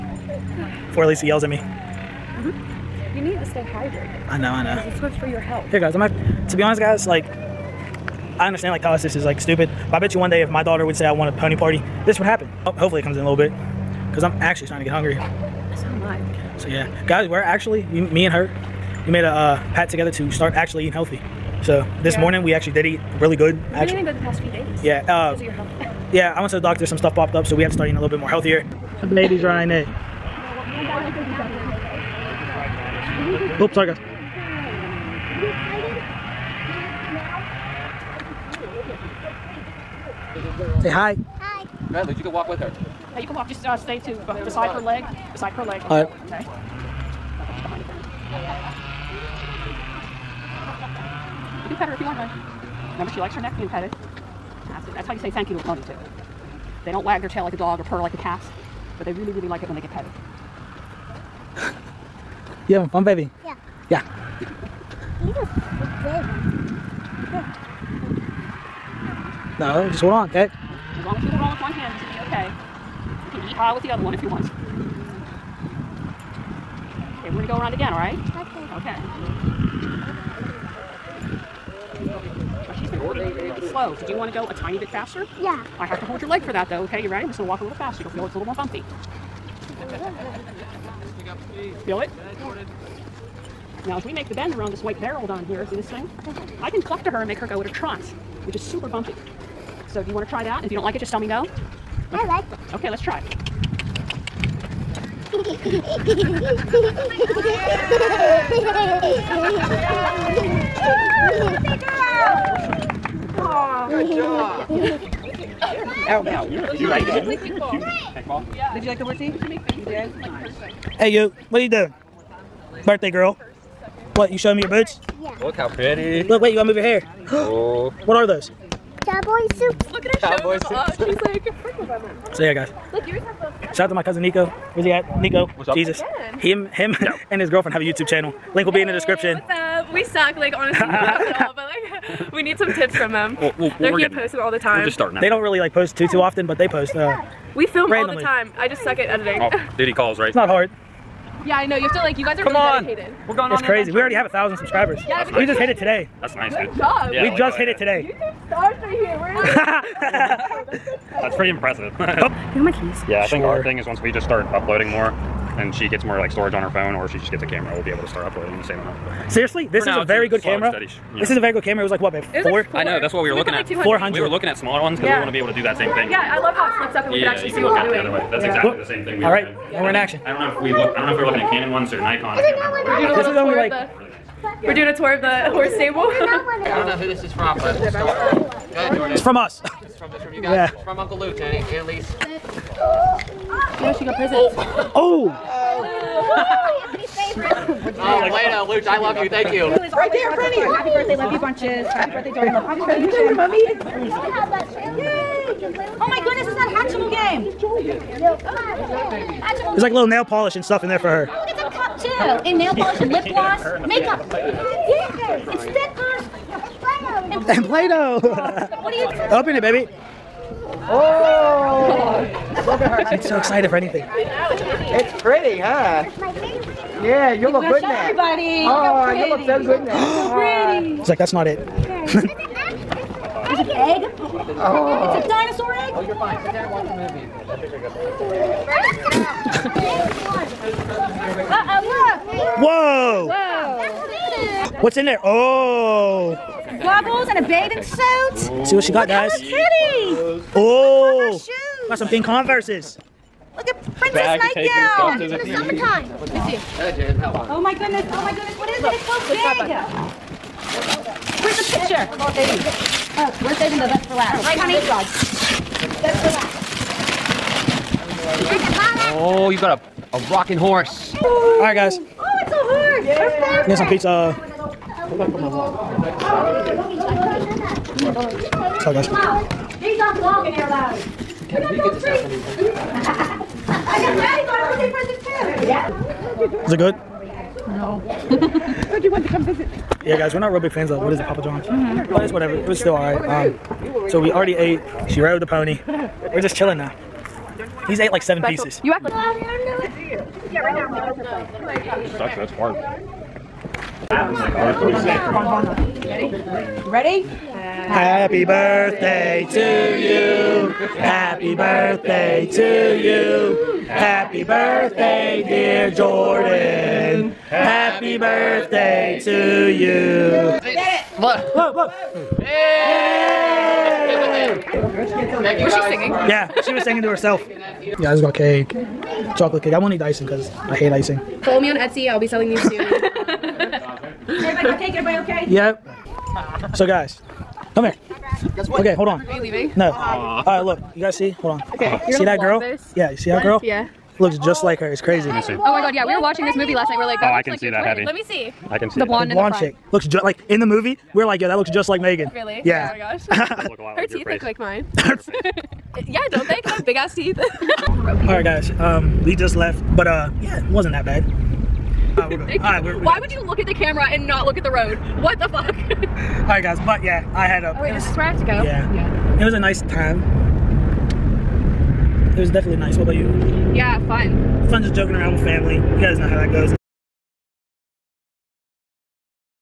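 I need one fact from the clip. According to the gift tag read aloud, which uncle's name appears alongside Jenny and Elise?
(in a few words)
Uncle Lou.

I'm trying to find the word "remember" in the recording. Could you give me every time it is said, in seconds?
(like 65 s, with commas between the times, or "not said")
52 s, 182 s.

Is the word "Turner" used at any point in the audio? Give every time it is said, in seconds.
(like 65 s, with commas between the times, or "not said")
not said.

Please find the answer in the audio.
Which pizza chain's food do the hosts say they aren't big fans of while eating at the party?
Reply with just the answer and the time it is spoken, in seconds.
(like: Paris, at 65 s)
Papa John's, at 291 s.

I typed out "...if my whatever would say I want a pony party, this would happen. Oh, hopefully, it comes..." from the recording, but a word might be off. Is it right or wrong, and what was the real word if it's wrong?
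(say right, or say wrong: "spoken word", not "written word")
wrong: "daughter", not "whatever".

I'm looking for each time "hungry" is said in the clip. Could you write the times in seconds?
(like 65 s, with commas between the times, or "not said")
14 s.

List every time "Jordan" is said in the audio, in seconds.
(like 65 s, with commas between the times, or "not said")
188 s, 202 s, 315 s.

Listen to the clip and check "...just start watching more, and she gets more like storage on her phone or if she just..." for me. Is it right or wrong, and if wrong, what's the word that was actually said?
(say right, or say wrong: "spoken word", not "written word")
wrong: "uploading", not "watching".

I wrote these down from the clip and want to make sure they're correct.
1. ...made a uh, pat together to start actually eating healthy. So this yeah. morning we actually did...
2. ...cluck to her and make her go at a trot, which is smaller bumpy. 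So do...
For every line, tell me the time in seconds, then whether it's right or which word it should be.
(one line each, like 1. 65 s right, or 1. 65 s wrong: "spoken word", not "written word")
1. 19 s right
2. 96 s wrong: "super", not "smaller".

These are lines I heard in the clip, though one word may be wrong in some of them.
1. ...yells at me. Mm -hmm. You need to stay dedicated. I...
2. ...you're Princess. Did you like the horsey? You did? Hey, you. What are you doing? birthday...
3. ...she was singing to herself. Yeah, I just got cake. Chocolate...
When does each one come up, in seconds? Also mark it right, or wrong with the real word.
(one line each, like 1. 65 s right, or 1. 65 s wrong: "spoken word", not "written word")
1. 1 s wrong: "hydrated", not "dedicated"
2. 116 s wrong: "Yeah", not "Princess"
3. 326 s right.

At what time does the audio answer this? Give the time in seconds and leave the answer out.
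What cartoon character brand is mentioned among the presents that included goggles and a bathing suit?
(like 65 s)
249 s.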